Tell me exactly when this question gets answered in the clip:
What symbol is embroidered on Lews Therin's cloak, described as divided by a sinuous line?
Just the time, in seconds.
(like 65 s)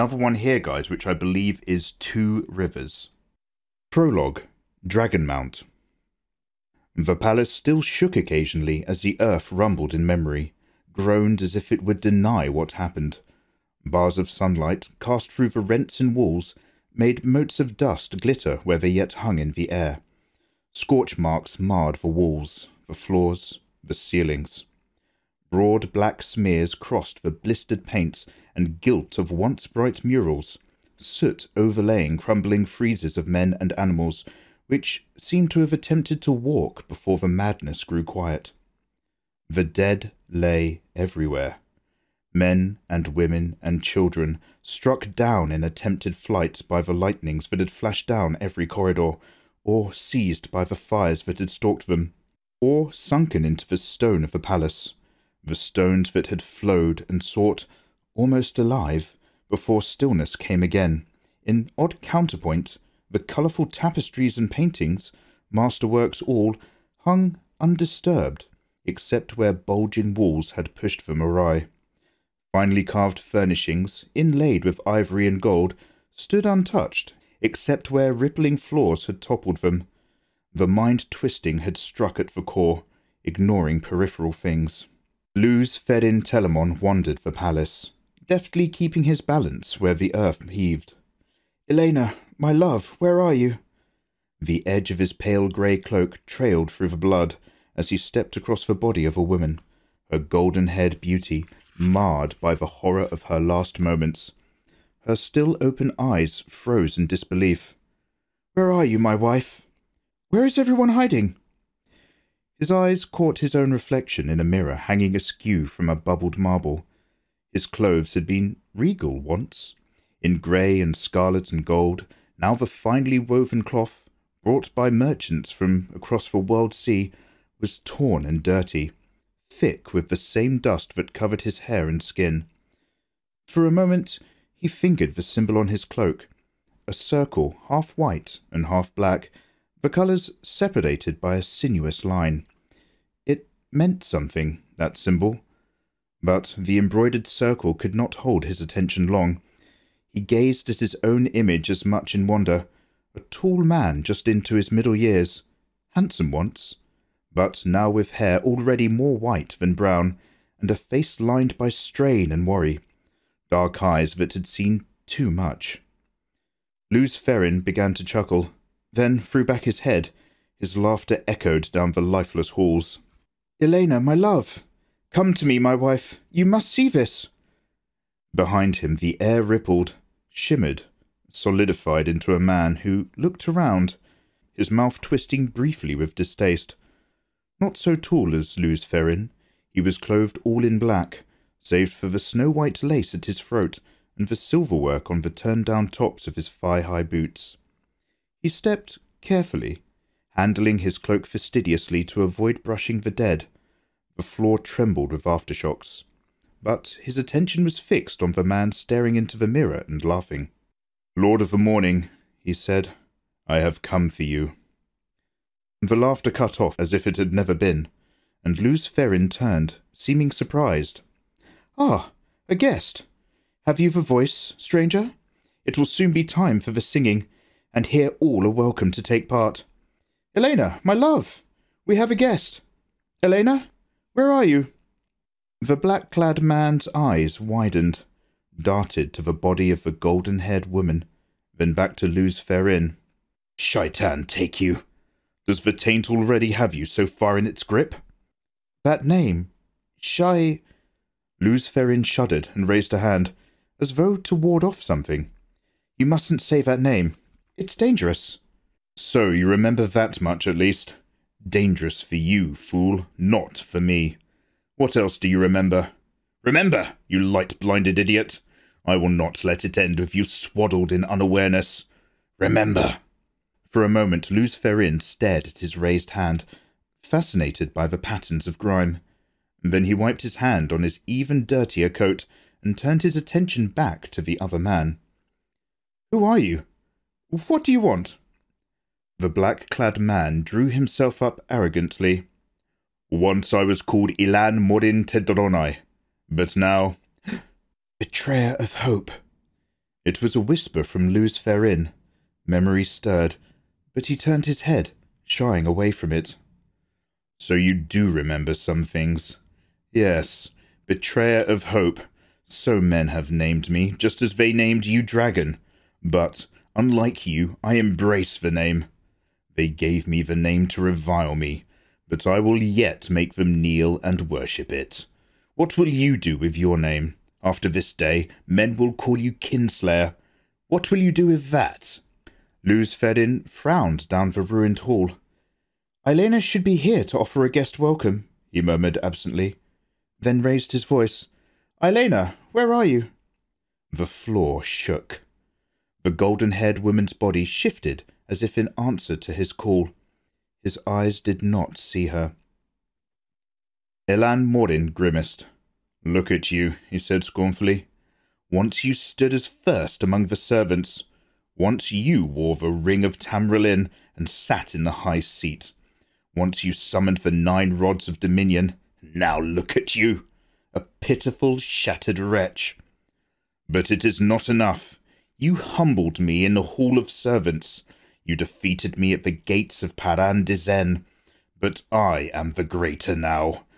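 136 s.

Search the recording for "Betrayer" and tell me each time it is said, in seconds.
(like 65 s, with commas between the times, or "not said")
297 s, 310 s.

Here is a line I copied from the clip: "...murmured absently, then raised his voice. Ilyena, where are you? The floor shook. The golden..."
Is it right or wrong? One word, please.
right.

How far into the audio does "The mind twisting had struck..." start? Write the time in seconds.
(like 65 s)
80 s.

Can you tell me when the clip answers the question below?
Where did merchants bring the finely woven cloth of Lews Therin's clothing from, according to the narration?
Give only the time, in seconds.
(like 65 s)
125 s.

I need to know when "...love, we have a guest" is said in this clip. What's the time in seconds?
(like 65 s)
230 s.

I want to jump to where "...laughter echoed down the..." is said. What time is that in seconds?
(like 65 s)
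170 s.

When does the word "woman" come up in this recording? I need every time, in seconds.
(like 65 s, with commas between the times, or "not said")
99 s, 240 s, 346 s.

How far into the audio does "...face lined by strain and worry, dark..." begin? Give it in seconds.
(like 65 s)
160 s.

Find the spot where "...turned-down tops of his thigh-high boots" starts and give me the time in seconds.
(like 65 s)
195 s.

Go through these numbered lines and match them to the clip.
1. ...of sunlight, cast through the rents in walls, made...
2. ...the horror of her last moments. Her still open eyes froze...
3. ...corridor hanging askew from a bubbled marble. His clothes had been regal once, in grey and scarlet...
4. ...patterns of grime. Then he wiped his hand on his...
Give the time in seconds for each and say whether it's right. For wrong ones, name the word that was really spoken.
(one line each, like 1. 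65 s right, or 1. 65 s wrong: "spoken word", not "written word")
1. 14 s right
2. 102 s right
3. 114 s wrong: "mirror", not "corridor"
4. 277 s right.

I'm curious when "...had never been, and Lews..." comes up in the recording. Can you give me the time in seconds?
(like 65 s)
217 s.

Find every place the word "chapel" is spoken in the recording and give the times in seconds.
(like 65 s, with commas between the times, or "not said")
not said.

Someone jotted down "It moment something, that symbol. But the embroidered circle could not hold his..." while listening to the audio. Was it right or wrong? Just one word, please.
wrong.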